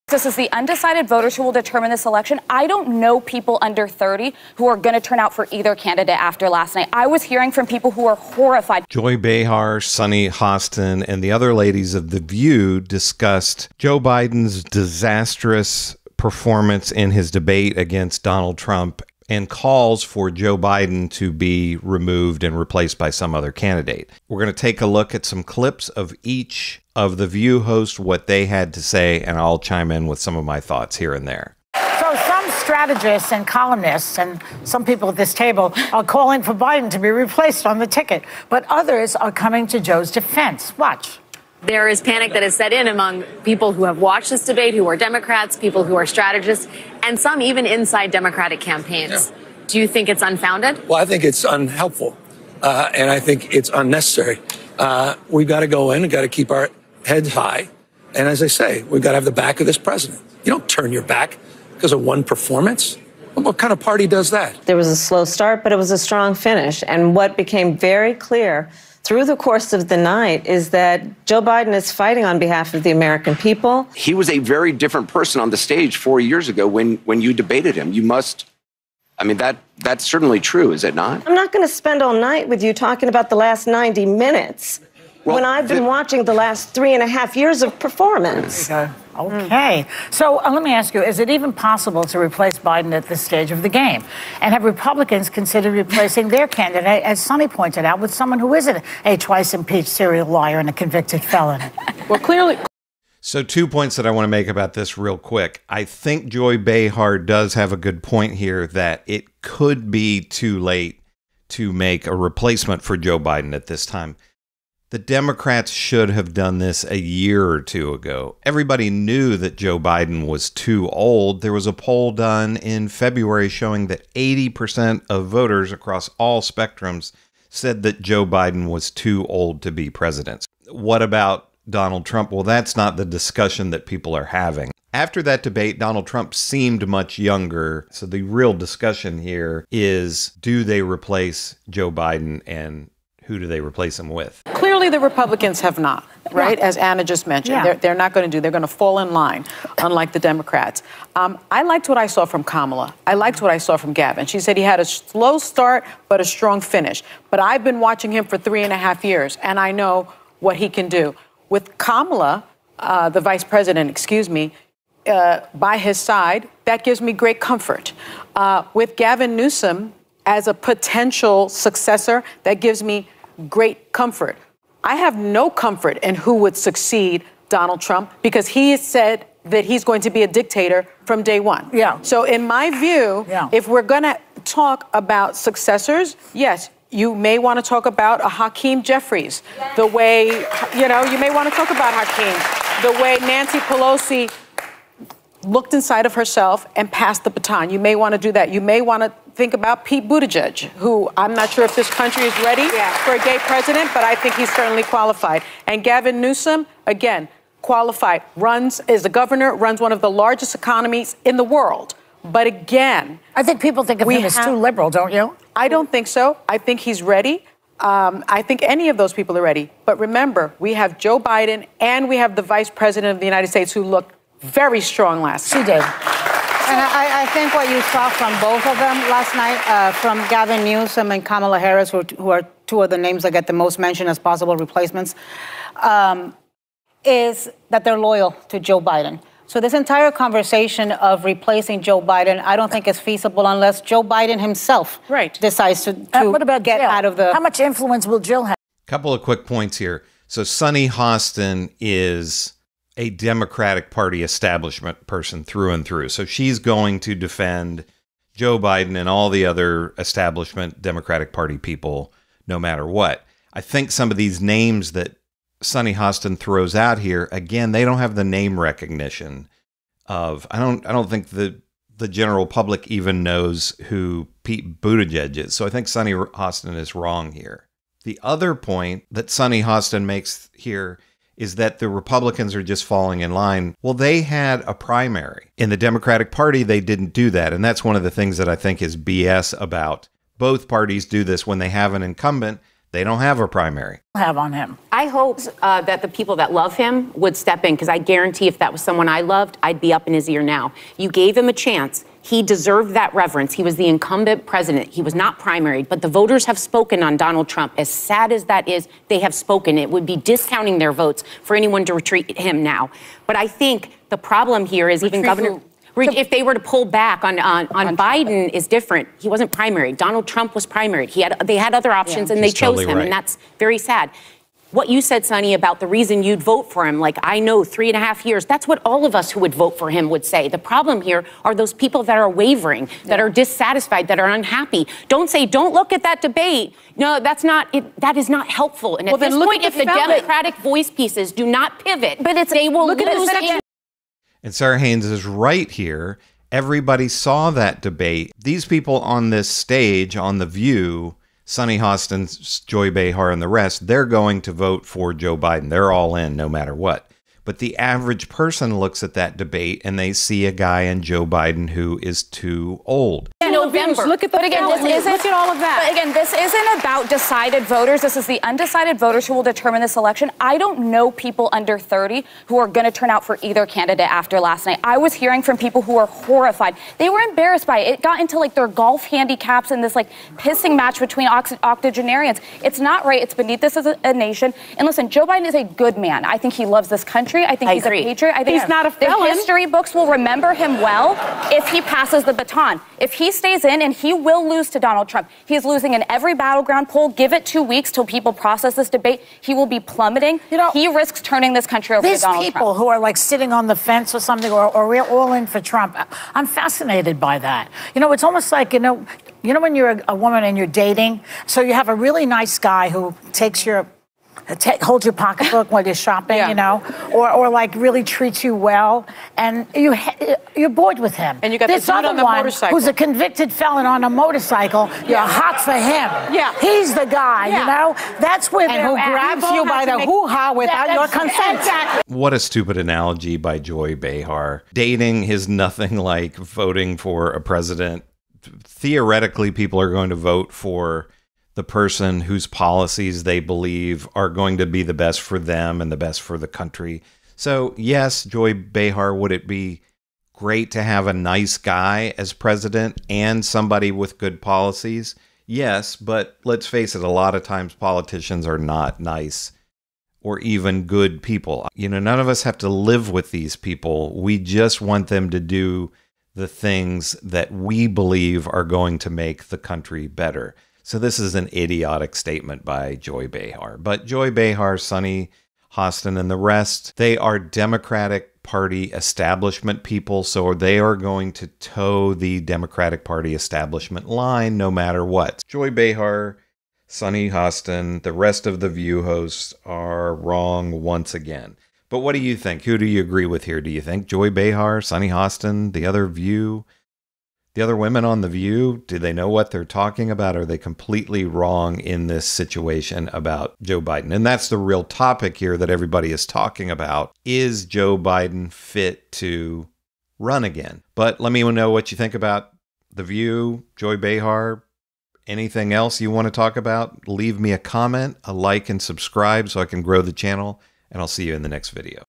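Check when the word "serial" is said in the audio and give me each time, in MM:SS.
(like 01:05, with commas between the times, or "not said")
01:39.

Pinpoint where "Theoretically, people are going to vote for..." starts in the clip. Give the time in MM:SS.
07:18.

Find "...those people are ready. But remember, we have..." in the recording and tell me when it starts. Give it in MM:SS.
03:38.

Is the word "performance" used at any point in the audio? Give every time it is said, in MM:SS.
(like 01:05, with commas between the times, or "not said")
00:16, 01:02, 01:27.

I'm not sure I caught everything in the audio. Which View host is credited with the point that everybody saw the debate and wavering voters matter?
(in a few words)
Sara Haines.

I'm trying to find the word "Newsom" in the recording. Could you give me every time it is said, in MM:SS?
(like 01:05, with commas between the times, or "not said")
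02:49, 03:26, 03:50.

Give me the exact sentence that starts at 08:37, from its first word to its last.
Leave me a comment, a like, and subscribe so I can grow the channel.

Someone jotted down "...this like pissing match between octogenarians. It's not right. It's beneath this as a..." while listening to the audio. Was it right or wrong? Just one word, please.
right.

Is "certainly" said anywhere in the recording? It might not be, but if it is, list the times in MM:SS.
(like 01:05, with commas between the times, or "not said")
01:20, 03:24.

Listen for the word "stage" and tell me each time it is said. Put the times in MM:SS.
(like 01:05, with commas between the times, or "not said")
01:15, 01:33, 05:49.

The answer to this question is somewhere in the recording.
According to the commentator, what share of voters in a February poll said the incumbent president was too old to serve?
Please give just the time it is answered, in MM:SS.
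02:04.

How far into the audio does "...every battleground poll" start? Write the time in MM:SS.
06:36.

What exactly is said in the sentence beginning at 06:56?
you know, or, or like really treats you well, and you you're bored with him.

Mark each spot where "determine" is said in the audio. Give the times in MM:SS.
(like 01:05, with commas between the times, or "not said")
00:01, 06:09.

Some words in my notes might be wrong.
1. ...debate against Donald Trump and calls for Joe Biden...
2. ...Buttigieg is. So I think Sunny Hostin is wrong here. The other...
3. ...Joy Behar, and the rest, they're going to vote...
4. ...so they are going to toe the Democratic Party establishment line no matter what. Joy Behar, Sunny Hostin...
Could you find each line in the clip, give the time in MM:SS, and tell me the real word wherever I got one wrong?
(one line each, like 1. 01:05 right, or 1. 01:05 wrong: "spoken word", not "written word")
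1. 00:17 right
2. 04:34 right
3. 05:52 right
4. 08:00 right.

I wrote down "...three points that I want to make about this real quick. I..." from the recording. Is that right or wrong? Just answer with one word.
wrong.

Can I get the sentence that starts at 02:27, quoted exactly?
they're, they're not going to do.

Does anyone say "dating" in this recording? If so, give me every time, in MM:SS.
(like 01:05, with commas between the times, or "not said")
06:50, 07:14.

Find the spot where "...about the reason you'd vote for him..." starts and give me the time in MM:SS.
05:25.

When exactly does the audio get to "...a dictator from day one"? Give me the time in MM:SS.
03:00.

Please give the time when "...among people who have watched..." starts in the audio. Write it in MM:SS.
00:42.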